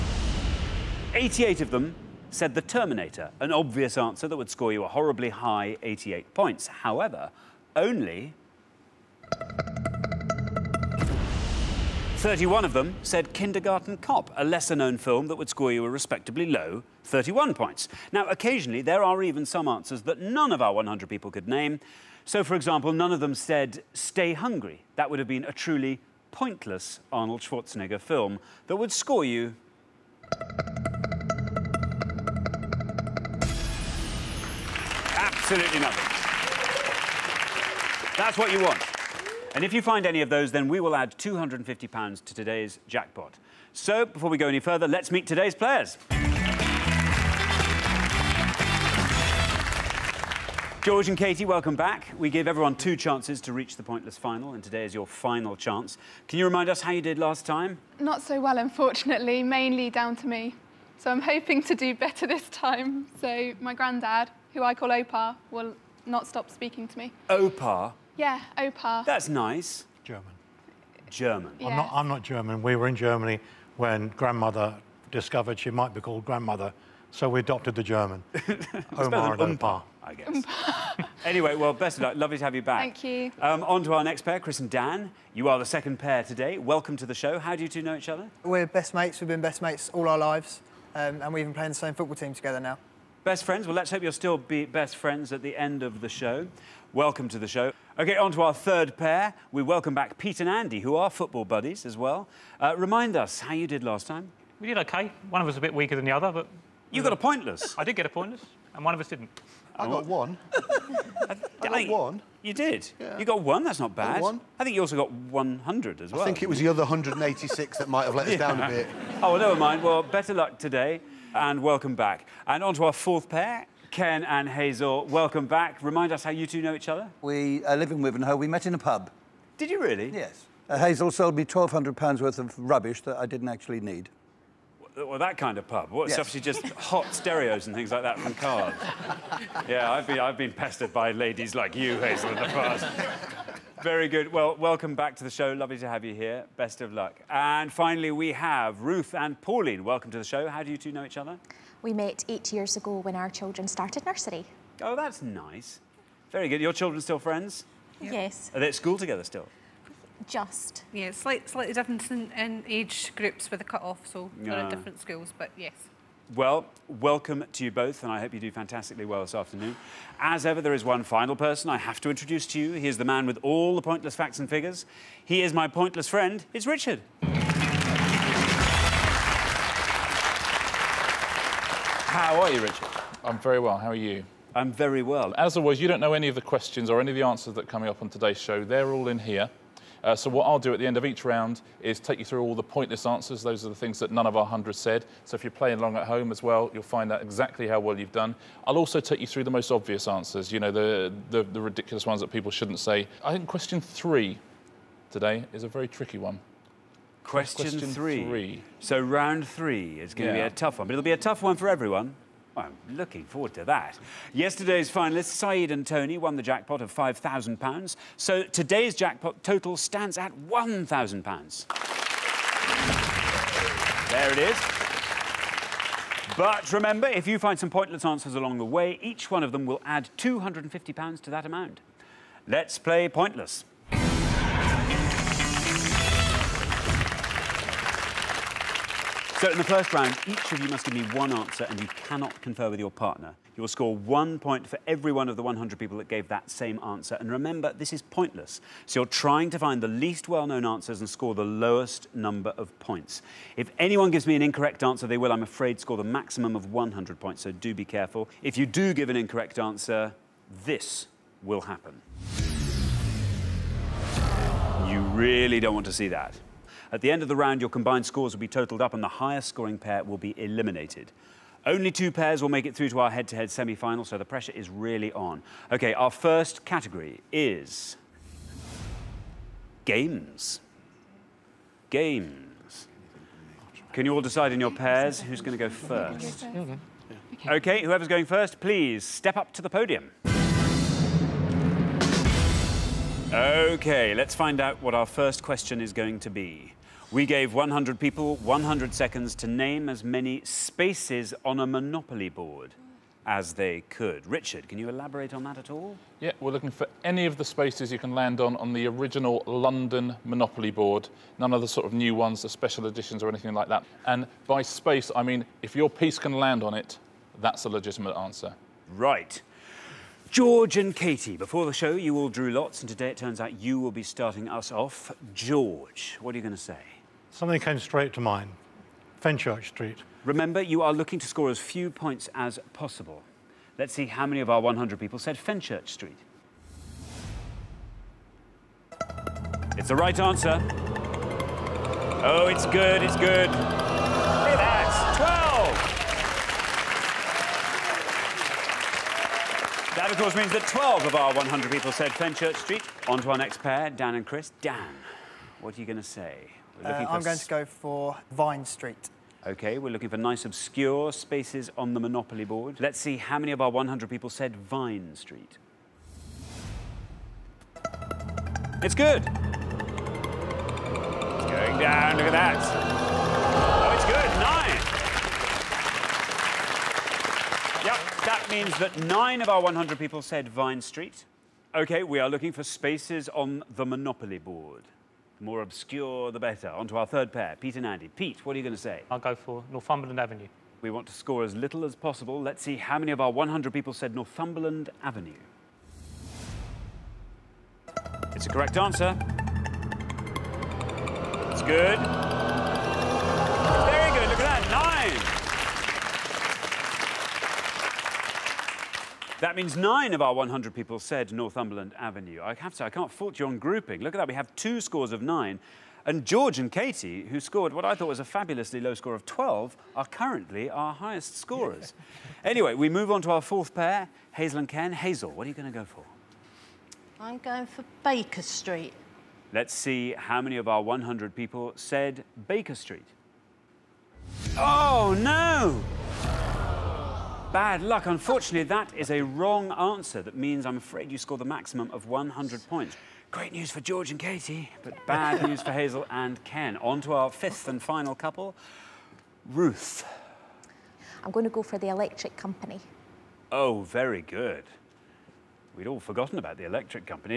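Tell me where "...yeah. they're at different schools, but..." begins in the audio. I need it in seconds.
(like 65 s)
164 s.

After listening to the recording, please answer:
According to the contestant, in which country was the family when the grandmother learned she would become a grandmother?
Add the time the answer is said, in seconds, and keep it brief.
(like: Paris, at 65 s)
Germany, at 72 s.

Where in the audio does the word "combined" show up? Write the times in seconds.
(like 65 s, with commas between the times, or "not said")
267 s.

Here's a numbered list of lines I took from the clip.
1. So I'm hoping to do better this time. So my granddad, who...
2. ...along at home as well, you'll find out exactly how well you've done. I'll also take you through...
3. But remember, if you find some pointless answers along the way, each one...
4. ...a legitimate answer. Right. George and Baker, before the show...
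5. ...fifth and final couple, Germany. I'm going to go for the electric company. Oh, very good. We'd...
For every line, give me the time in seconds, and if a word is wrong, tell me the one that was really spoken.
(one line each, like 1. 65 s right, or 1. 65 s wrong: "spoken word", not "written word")
1. 60 s right
2. 195 s right
3. 226 s right
4. 317 s wrong: "Katie", not "Baker"
5. 447 s wrong: "Ruth", not "Germany".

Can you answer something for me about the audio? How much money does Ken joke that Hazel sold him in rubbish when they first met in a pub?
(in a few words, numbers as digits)
£1,200.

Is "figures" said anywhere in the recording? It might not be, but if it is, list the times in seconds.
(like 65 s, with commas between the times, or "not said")
174 s.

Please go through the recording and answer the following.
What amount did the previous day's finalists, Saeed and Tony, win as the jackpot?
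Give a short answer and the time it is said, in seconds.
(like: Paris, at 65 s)
£5,000, at 216 s.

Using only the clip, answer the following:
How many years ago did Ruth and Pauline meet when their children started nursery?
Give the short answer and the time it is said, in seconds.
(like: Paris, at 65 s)
8, at 152 s.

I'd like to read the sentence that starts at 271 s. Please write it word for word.
Only two pairs will make it through to our head-to-head -head semi-final, so the pressure is really on.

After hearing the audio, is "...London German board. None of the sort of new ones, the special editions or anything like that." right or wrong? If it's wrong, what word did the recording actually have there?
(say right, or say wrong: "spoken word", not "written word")
wrong: "Monopoly", not "German".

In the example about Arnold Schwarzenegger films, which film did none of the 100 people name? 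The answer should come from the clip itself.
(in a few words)
Stay Hungry.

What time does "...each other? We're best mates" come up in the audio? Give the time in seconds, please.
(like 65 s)
87 s.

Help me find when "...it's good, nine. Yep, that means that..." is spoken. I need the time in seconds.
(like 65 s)
377 s.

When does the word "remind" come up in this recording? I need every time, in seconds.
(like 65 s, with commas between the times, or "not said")
56 s, 102 s, 125 s.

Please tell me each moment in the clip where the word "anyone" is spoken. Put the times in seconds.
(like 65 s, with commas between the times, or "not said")
253 s.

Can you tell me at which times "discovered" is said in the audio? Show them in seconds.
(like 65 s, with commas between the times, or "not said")
75 s.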